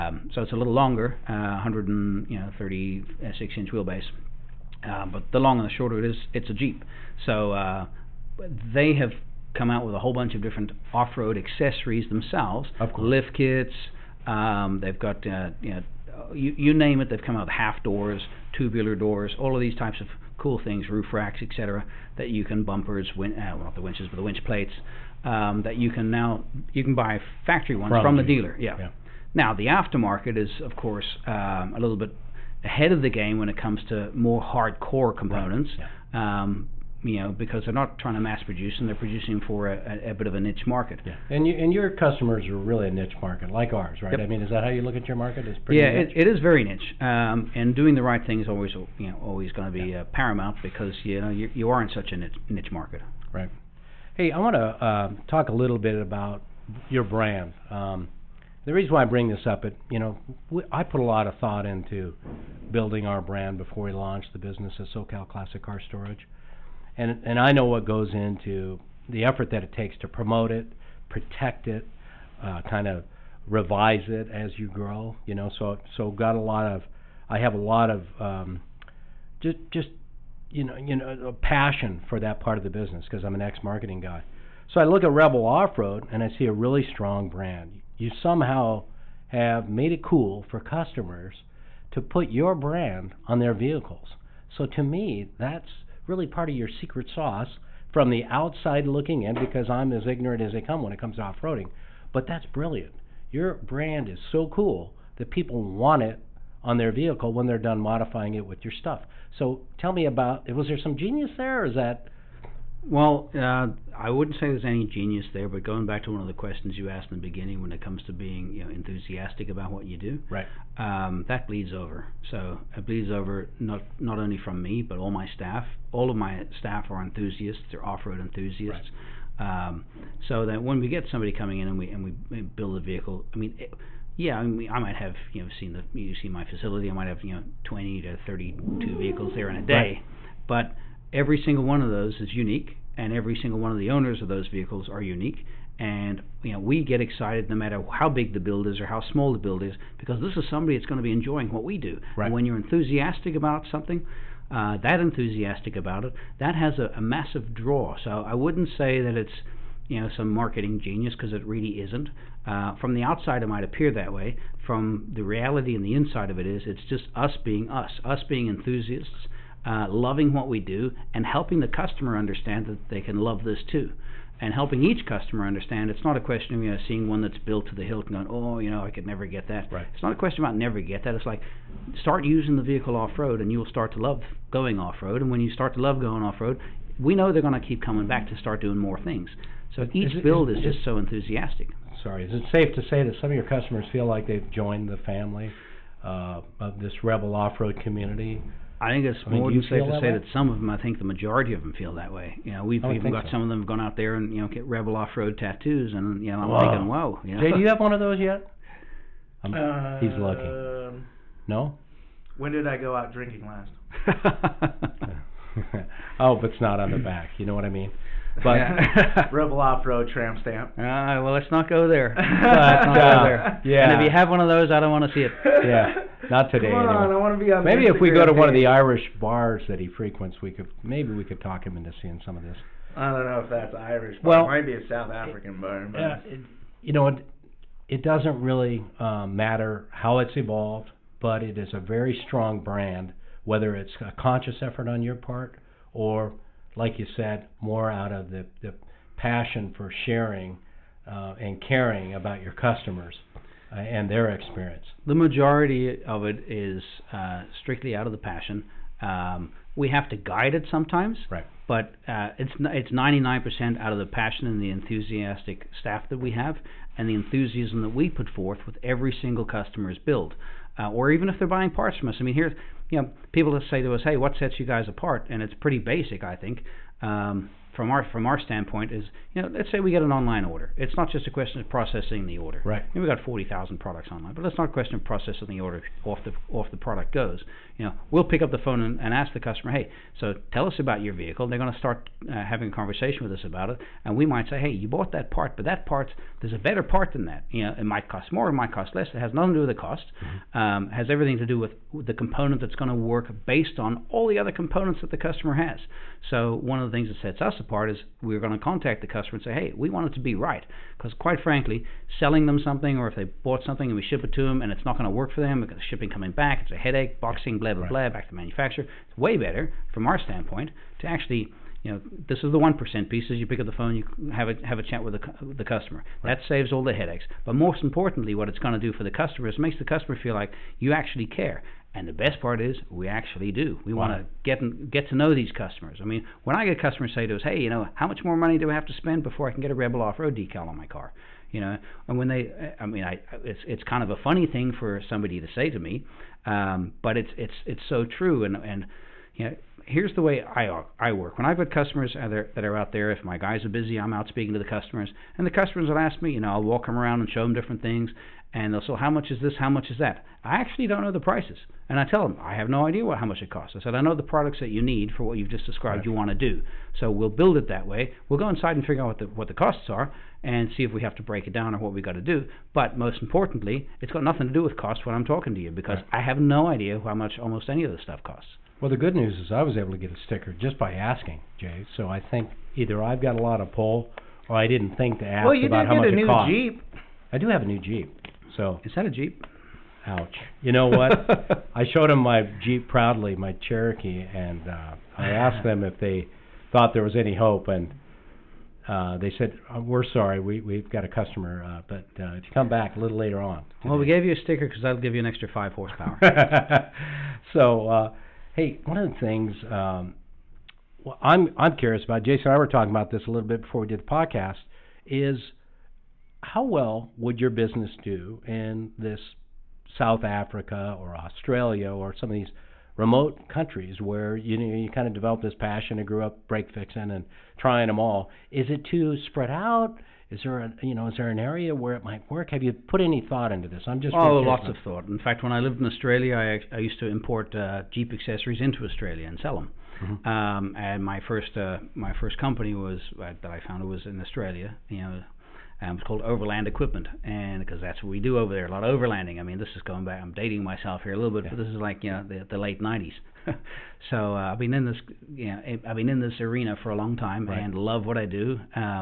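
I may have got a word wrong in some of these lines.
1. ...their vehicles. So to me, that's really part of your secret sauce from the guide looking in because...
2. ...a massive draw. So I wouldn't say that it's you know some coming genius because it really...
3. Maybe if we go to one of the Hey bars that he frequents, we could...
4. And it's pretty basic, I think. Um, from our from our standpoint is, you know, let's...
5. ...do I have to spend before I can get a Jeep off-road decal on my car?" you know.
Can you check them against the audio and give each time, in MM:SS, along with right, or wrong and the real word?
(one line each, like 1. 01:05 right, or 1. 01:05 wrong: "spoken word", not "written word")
1. 01:33 wrong: "outside", not "guide"
2. 02:36 wrong: "marketing", not "coming"
3. 03:47 wrong: "Irish", not "Hey"
4. 04:35 right
5. 05:38 wrong: "Rebel", not "Jeep".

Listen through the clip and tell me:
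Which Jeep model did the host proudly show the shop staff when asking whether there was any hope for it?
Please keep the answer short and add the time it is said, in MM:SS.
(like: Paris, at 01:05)
Cherokee, at 06:33.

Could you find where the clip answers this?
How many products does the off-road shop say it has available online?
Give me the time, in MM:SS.
04:43.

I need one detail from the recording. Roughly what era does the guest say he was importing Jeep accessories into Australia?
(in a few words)
late '90s.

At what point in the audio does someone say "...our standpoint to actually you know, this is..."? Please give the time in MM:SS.
05:20.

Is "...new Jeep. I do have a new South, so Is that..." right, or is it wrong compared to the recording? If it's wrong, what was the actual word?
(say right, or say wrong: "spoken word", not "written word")
wrong: "Jeep", not "South".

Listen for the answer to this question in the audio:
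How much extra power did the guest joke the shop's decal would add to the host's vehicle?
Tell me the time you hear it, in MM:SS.
06:45.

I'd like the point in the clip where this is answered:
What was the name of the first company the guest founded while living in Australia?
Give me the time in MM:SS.
07:26.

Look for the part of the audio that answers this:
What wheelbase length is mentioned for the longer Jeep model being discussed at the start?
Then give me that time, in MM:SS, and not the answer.
00:01.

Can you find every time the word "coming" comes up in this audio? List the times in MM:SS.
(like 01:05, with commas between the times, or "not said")
02:11, 03:07, 05:16.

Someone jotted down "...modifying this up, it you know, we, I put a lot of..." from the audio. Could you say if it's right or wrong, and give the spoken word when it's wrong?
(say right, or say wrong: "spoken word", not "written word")
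wrong: "bring", not "modifying".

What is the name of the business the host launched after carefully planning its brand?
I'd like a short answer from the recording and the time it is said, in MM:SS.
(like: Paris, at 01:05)
SoCal Classic Car Storage, at 01:04.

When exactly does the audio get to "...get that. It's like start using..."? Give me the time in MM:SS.
03:00.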